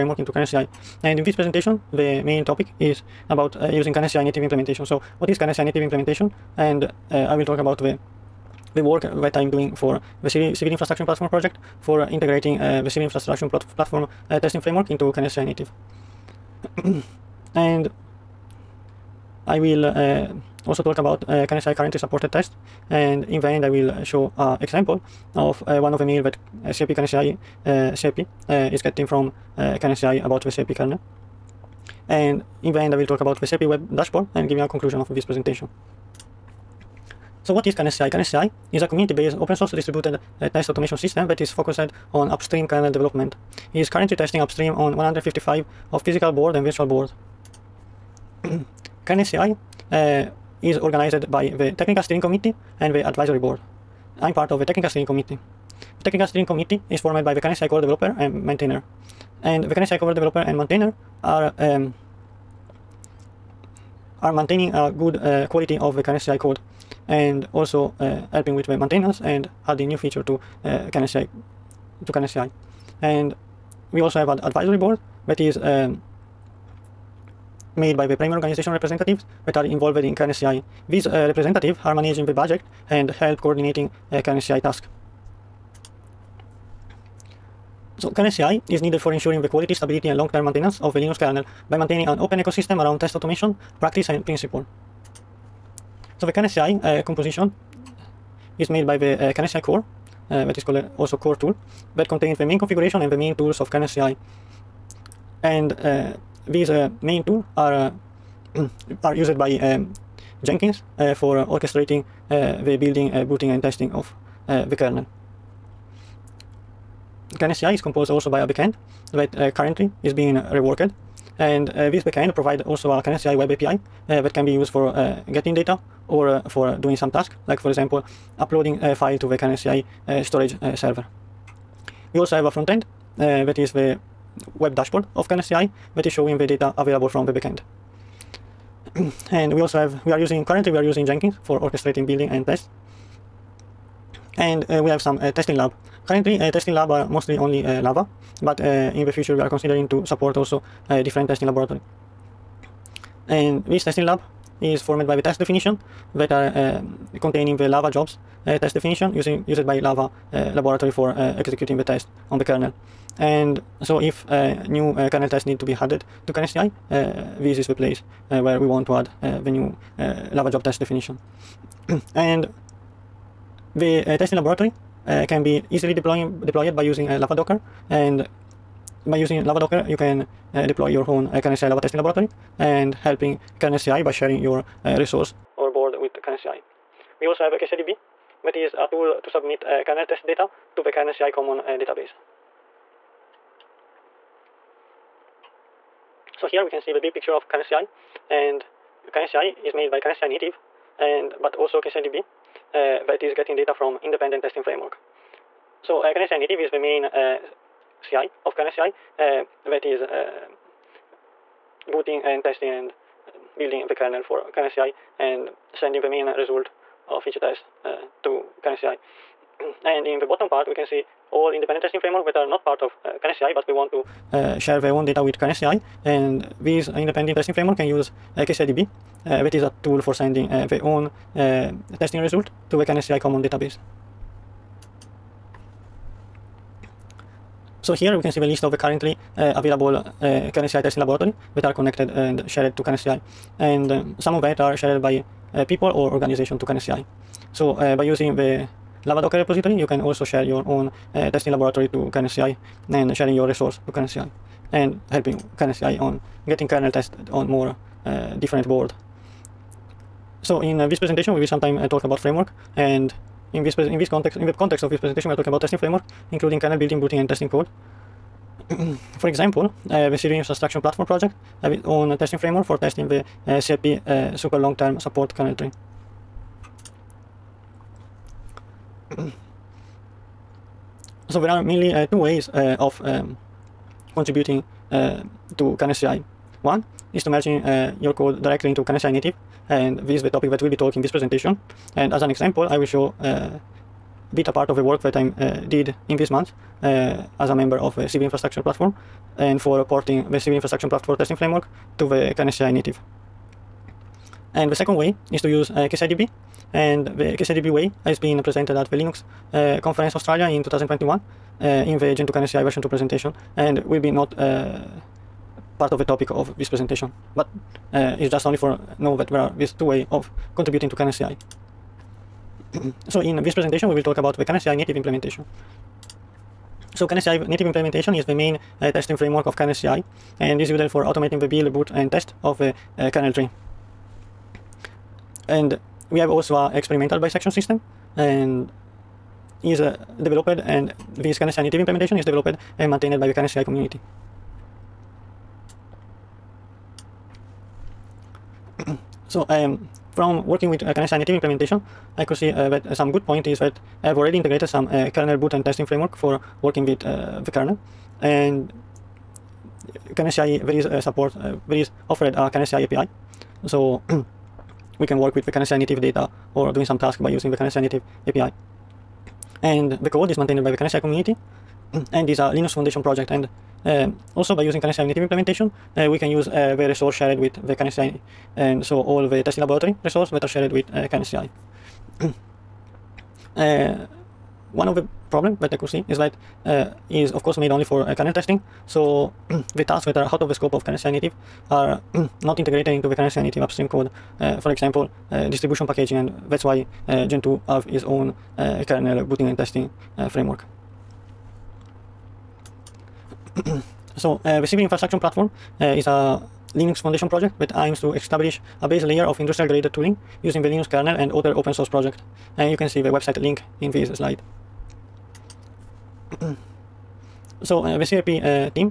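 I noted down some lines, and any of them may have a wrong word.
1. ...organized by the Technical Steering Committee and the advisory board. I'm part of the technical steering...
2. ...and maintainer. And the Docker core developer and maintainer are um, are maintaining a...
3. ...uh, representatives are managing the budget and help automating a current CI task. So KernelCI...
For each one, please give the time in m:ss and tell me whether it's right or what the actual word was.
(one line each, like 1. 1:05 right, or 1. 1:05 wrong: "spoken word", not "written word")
1. 0:50 right
2. 0:58 wrong: "KernelCI", not "Docker"
3. 1:21 wrong: "coordinating", not "automating".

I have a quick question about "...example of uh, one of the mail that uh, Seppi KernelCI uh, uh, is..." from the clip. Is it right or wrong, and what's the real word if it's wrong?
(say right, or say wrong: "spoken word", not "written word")
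right.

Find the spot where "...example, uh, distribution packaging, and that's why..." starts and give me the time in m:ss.
6:34.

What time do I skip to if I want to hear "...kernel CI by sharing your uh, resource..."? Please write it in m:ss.
3:03.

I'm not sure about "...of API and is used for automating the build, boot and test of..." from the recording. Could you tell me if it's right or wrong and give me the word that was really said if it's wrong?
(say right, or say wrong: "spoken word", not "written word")
wrong: "KernelCI", not "API".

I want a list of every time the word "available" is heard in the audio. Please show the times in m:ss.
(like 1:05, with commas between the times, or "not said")
2:16, 3:59.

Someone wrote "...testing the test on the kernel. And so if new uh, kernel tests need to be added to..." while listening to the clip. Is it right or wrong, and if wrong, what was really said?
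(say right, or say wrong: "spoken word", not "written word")
wrong: "executing", not "testing".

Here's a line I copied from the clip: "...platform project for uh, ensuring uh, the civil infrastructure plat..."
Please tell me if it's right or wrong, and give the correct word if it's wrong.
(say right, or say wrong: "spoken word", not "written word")
wrong: "integrating", not "ensuring".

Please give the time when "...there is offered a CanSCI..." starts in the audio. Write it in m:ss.
6:01.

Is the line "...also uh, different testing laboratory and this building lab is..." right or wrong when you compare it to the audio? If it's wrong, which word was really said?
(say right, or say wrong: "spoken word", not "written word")
wrong: "testing", not "building".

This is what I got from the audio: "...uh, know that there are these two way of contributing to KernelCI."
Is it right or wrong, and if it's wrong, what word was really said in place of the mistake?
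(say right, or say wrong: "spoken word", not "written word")
right.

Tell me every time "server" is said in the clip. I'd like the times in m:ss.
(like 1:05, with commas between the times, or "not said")
2:10.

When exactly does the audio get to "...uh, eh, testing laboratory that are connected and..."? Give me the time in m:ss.
3:59.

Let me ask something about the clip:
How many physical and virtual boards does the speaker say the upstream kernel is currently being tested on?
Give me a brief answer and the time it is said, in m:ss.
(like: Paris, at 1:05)
155, at 0:44.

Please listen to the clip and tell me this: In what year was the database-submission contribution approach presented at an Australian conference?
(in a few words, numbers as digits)
2021.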